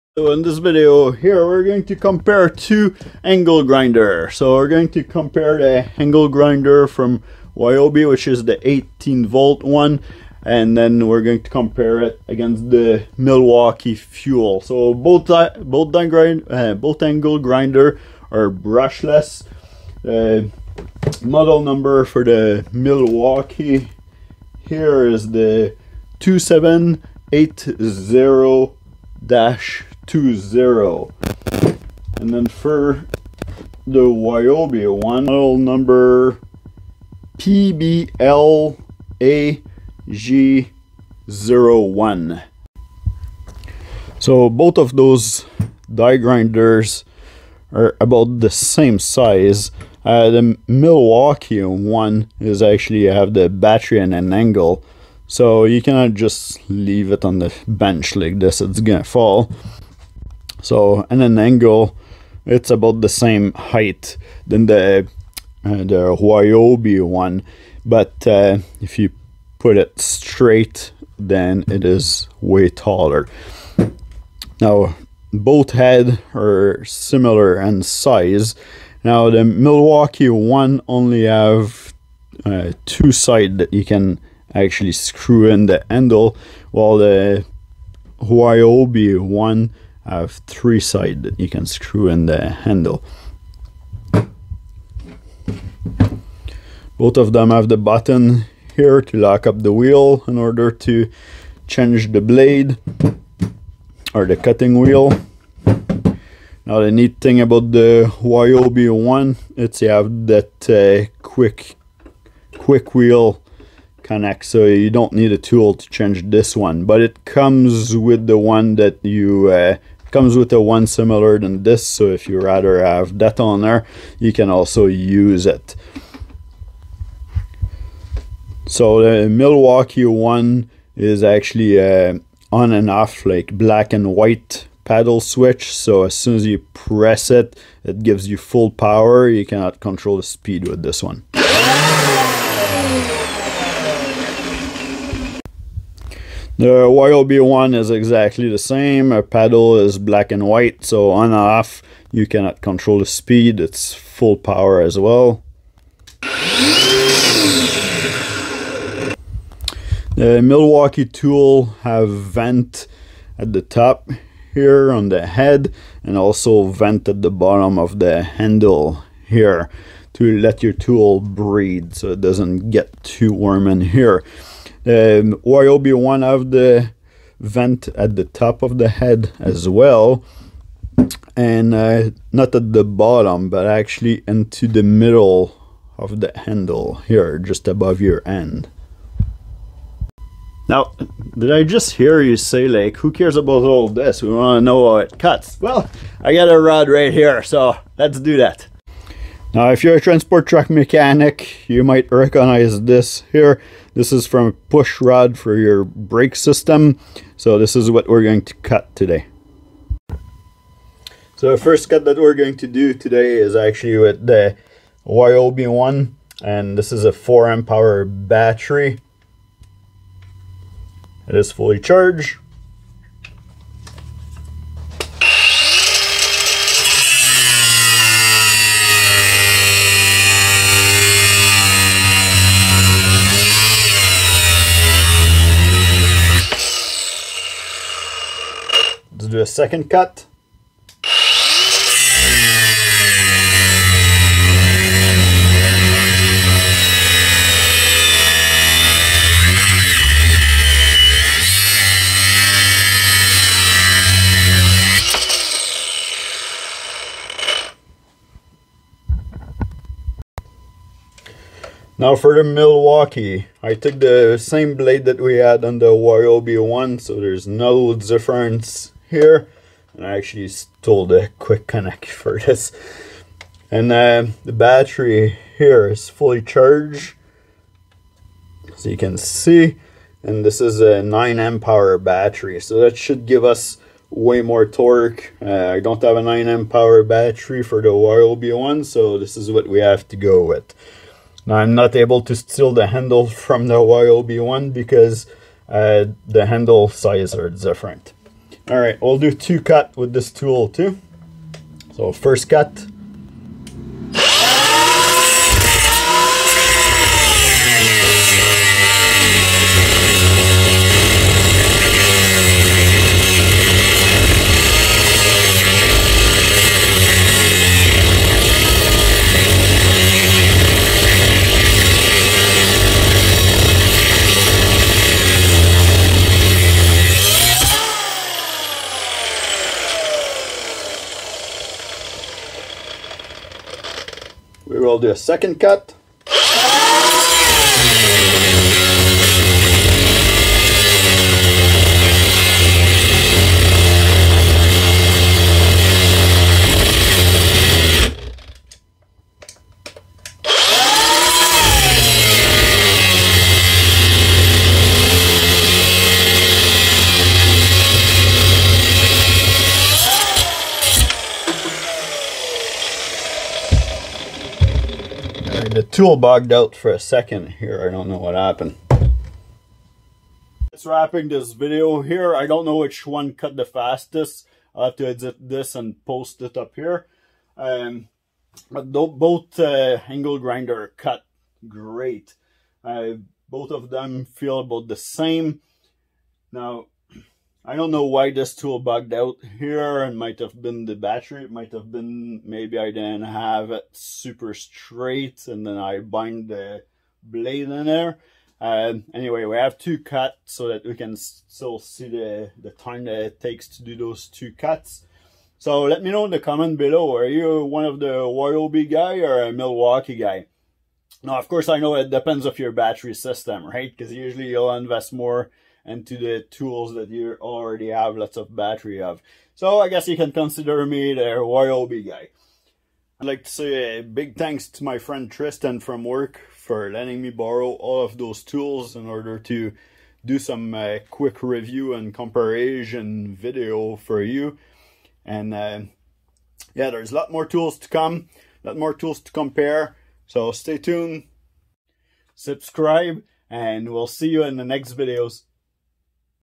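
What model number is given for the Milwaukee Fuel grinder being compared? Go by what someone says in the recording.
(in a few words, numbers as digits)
2780-20.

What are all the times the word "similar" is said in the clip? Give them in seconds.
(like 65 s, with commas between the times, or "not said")
76 s, 120 s.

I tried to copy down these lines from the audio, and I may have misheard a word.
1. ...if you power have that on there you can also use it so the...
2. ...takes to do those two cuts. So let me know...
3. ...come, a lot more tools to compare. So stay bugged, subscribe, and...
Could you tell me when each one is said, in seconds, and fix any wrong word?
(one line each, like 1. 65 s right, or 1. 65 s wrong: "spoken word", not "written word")
1. 122 s wrong: "rather", not "power"
2. 403 s right
3. 437 s wrong: "tuned", not "bugged".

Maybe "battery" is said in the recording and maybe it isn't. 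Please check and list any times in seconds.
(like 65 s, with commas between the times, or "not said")
53 s, 218 s, 274 s, 281 s, 287 s, 390 s, 412 s, 418 s.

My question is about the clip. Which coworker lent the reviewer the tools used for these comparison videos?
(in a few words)
Tristan.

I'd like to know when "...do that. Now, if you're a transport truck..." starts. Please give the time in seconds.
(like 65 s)
198 s.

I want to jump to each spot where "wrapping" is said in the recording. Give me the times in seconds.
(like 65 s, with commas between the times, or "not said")
370 s.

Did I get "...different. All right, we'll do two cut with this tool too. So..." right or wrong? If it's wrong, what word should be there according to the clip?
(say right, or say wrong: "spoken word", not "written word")
right.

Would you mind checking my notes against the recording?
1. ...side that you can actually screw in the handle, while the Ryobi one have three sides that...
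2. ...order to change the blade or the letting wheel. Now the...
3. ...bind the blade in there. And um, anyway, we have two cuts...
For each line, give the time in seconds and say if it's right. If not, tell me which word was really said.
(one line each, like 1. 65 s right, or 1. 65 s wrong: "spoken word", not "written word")
1. 83 s right
2. 100 s wrong: "cutting", not "letting"
3. 395 s right.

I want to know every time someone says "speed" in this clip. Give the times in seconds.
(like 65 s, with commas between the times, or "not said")
140 s, 153 s.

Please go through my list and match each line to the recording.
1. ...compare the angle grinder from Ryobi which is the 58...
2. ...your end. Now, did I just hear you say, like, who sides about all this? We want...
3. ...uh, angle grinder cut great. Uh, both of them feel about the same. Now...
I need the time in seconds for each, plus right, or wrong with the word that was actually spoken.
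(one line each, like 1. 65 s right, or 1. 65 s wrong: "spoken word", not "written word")
1. 5 s wrong: "18", not "58"
2. 188 s wrong: "cares", not "sides"
3. 379 s right.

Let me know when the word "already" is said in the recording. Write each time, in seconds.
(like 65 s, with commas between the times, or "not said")
417 s.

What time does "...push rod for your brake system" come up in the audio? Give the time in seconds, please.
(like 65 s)
204 s.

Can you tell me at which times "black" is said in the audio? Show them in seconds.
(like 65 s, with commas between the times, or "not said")
133 s, 149 s.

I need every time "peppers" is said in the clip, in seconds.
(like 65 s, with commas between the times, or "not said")
not said.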